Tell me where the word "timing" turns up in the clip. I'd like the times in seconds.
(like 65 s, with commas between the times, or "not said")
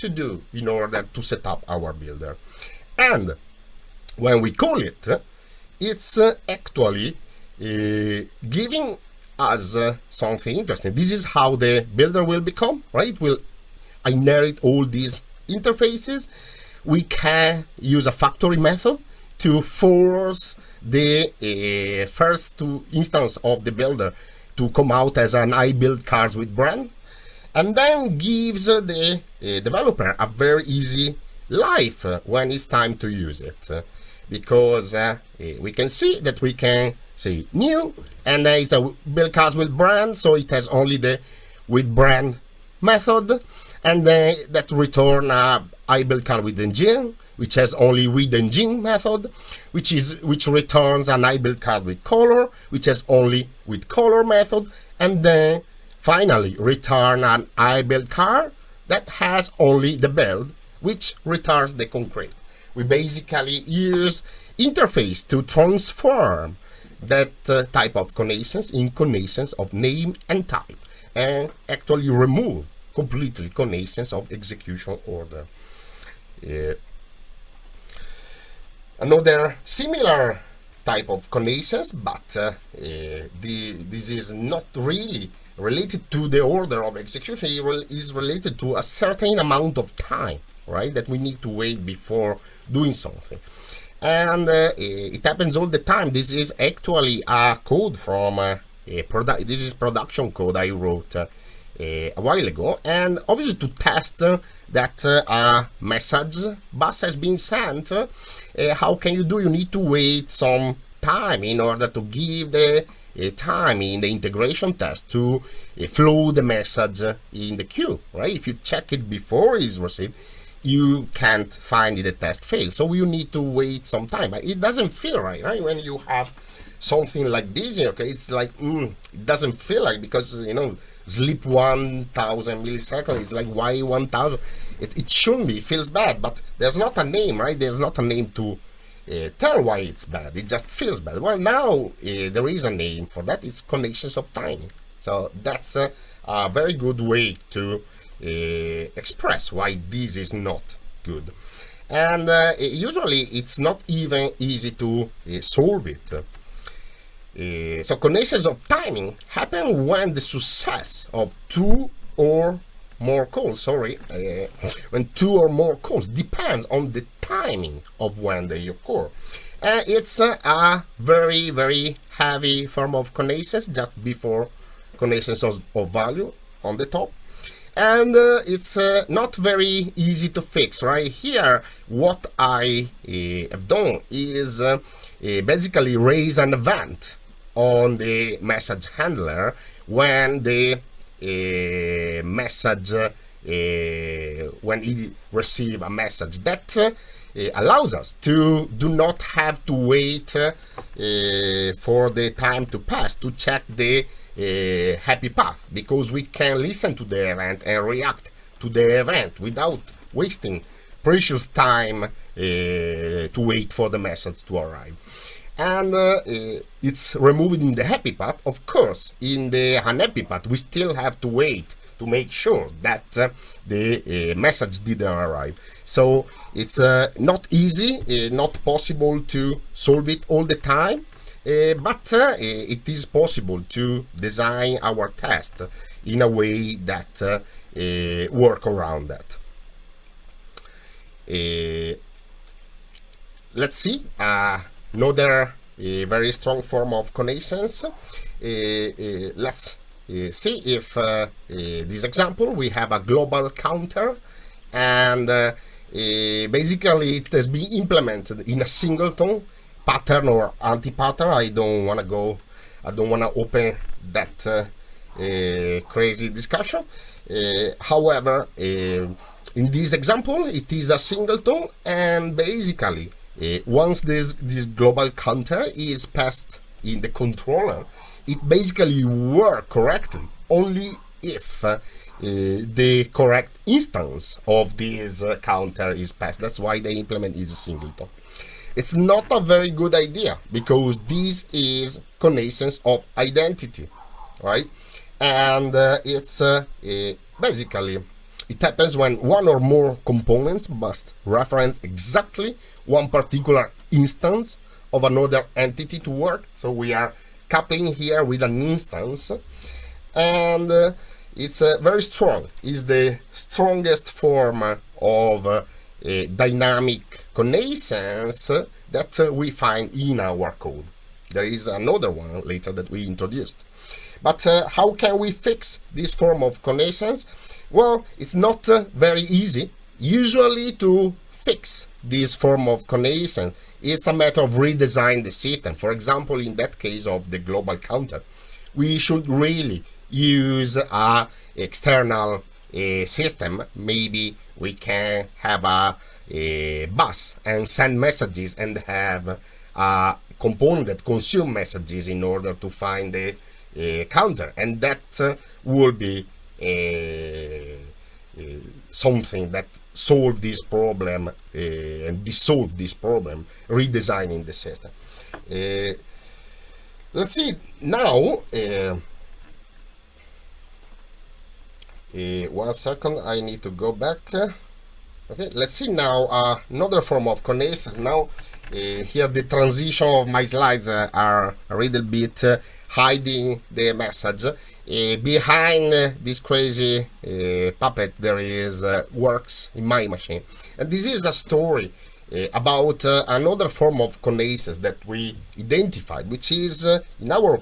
144 s, 158 s, 167 s.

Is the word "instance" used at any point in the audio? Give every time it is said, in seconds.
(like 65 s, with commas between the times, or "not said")
22 s, 283 s, 303 s, 308 s.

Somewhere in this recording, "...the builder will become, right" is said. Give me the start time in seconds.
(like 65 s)
11 s.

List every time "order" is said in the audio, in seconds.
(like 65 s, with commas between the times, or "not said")
0 s, 75 s, 86 s, 111 s, 352 s.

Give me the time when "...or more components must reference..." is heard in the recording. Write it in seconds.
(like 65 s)
299 s.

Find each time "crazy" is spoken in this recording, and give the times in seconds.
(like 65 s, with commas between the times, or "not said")
265 s, 386 s.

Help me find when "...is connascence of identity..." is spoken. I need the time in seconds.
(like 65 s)
291 s.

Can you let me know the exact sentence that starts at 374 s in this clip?
Okay, let's see now uh, another form of connascence.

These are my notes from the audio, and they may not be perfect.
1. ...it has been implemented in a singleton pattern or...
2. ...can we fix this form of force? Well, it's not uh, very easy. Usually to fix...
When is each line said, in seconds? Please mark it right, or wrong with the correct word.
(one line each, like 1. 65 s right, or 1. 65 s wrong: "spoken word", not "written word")
1. 257 s right
2. 324 s wrong: "connascence", not "force".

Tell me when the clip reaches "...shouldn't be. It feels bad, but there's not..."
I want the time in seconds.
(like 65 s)
135 s.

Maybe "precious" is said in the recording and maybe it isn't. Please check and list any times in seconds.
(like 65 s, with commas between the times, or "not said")
211 s.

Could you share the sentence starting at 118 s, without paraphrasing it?
If you check it before it's received, you can't find the test fail.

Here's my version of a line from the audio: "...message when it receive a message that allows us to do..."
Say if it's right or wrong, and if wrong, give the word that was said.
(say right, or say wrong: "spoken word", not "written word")
right.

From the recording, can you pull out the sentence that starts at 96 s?
This is actually a code from uh, a product.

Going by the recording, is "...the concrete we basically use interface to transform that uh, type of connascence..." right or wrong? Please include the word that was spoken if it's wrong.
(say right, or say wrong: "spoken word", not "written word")
right.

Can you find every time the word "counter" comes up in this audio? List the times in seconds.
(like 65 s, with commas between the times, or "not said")
253 s, 275 s, 285 s, 337 s, 354 s.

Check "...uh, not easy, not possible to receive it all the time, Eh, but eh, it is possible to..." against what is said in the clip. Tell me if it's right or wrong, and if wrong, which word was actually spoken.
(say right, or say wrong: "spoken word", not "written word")
wrong: "solve", not "receive".